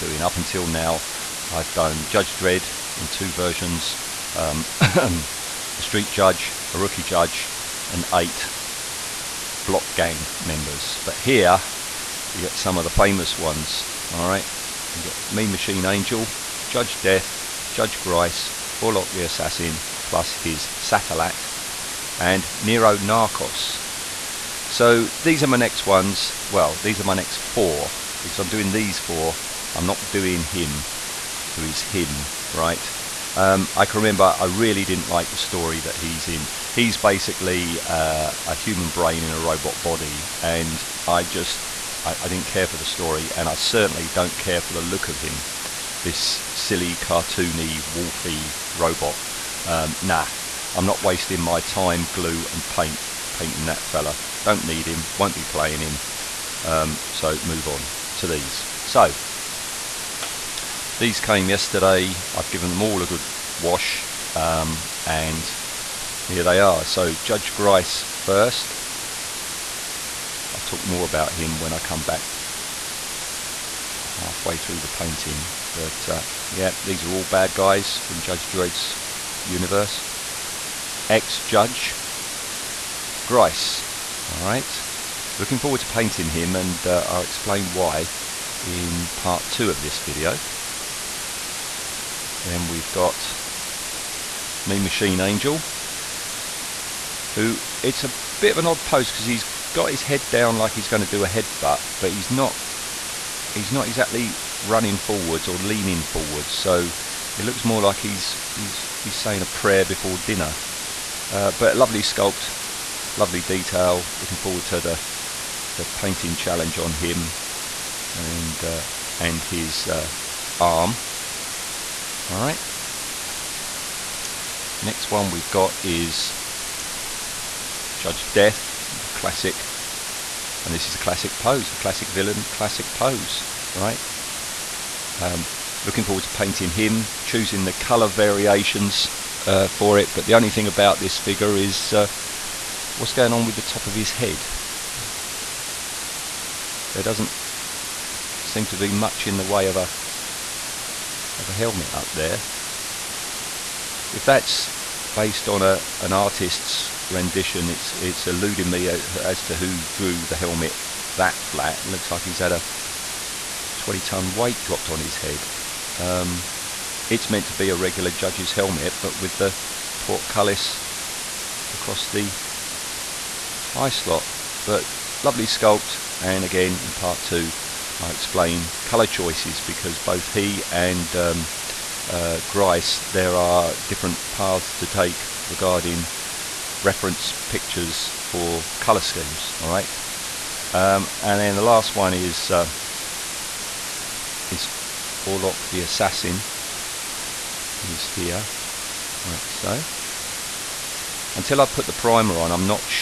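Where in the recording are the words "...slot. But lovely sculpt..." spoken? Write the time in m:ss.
2:53.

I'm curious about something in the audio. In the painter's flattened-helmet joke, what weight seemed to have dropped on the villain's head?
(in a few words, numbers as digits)
20 tons.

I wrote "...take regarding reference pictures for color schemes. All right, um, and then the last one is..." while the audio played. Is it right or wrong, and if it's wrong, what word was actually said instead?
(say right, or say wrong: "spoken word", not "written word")
right.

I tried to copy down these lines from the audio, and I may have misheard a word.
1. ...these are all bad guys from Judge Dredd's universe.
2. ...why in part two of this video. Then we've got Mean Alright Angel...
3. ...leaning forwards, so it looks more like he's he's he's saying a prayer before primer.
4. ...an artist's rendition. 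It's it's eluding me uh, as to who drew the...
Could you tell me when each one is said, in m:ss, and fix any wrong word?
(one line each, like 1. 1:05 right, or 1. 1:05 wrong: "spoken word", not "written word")
1. 1:16 right
2. 1:27 wrong: "Machine", not "Alright"
3. 1:45 wrong: "dinner", not "primer"
4. 2:36 right.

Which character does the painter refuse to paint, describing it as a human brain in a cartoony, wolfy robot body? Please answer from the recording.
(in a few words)
Nero Narcos.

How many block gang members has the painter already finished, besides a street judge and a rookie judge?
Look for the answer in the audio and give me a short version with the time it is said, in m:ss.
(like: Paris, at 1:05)
8, at 0:08.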